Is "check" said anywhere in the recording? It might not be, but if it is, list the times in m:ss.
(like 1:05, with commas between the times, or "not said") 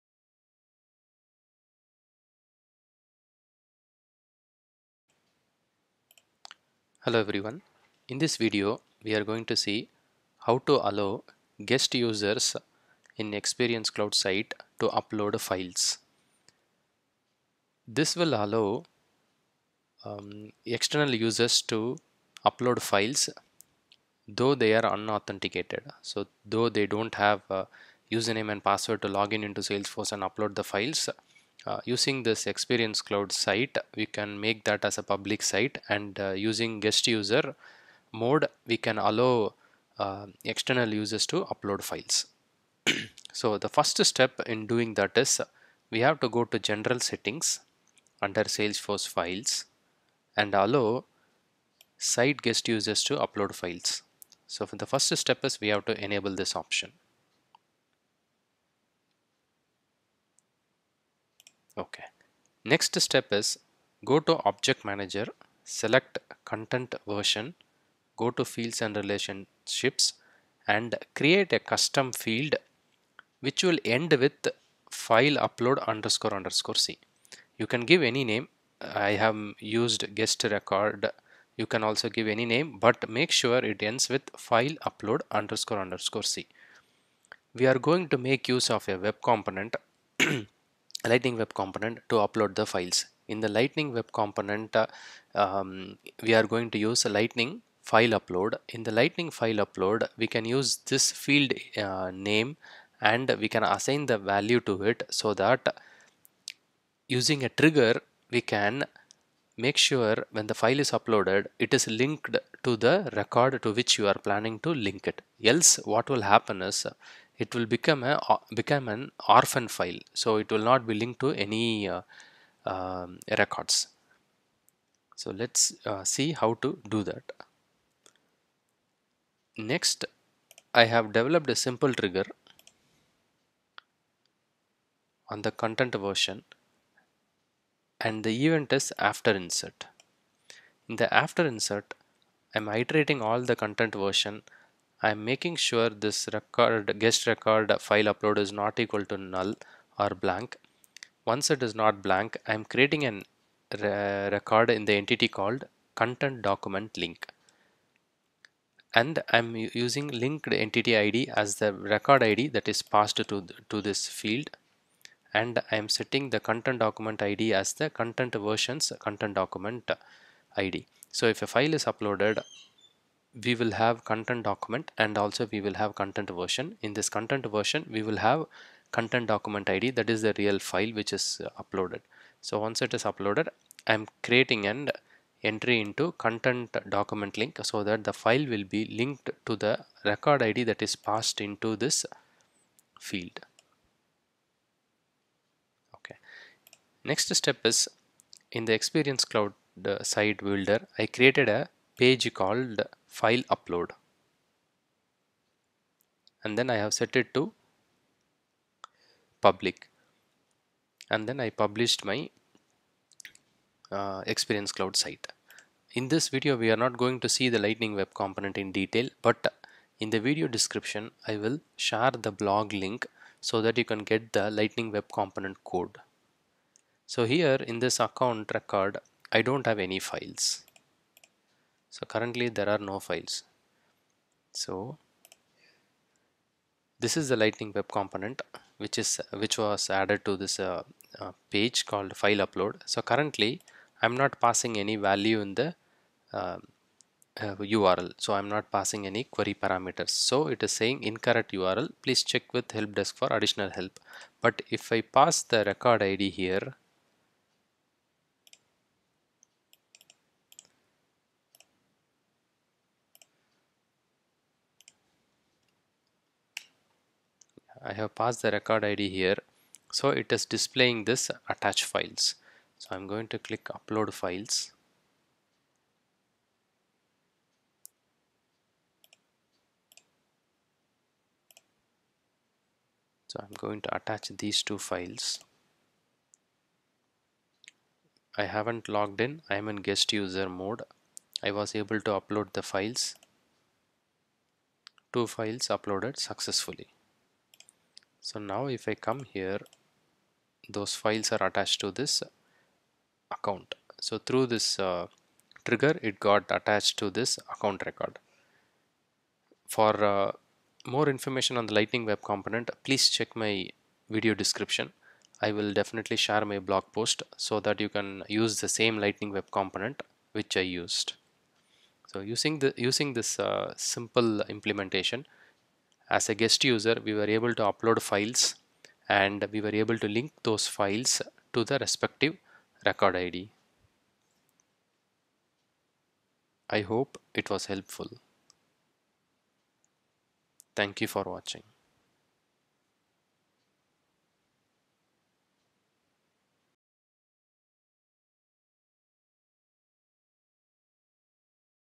4:12, 5:13.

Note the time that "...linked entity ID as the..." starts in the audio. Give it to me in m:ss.
2:40.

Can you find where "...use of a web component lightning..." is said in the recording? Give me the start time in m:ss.
1:28.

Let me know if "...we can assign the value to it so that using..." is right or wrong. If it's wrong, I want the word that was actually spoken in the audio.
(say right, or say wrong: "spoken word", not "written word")
right.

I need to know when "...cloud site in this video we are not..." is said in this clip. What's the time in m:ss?
3:34.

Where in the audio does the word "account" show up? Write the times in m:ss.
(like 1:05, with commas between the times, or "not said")
3:47, 5:03, 5:07.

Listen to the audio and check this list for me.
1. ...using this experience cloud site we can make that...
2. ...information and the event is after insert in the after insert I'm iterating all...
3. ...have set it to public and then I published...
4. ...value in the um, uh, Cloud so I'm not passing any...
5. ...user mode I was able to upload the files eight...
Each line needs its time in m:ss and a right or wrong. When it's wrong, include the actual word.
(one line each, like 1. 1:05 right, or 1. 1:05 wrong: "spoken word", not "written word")
1. 0:31 right
2. 2:16 wrong: "version", not "information"
3. 3:26 right
4. 4:04 wrong: "URL", not "Cloud"
5. 4:50 wrong: "two", not "eight".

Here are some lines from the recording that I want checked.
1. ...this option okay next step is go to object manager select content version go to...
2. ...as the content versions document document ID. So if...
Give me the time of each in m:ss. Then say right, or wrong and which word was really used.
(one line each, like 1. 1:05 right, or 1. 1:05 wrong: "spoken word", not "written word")
1. 0:56 right
2. 2:47 wrong: "content", not "document".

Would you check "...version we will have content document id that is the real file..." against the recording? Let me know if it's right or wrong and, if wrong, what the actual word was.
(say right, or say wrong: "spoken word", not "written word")
right.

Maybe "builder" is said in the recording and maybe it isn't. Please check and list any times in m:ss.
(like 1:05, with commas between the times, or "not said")
3:20.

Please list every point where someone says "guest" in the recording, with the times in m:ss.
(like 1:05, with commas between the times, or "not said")
0:11, 0:36, 0:52, 1:20, 2:27, 4:49, 5:26.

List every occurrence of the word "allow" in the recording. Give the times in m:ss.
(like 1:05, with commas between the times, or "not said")
0:10, 0:18, 0:38, 0:50.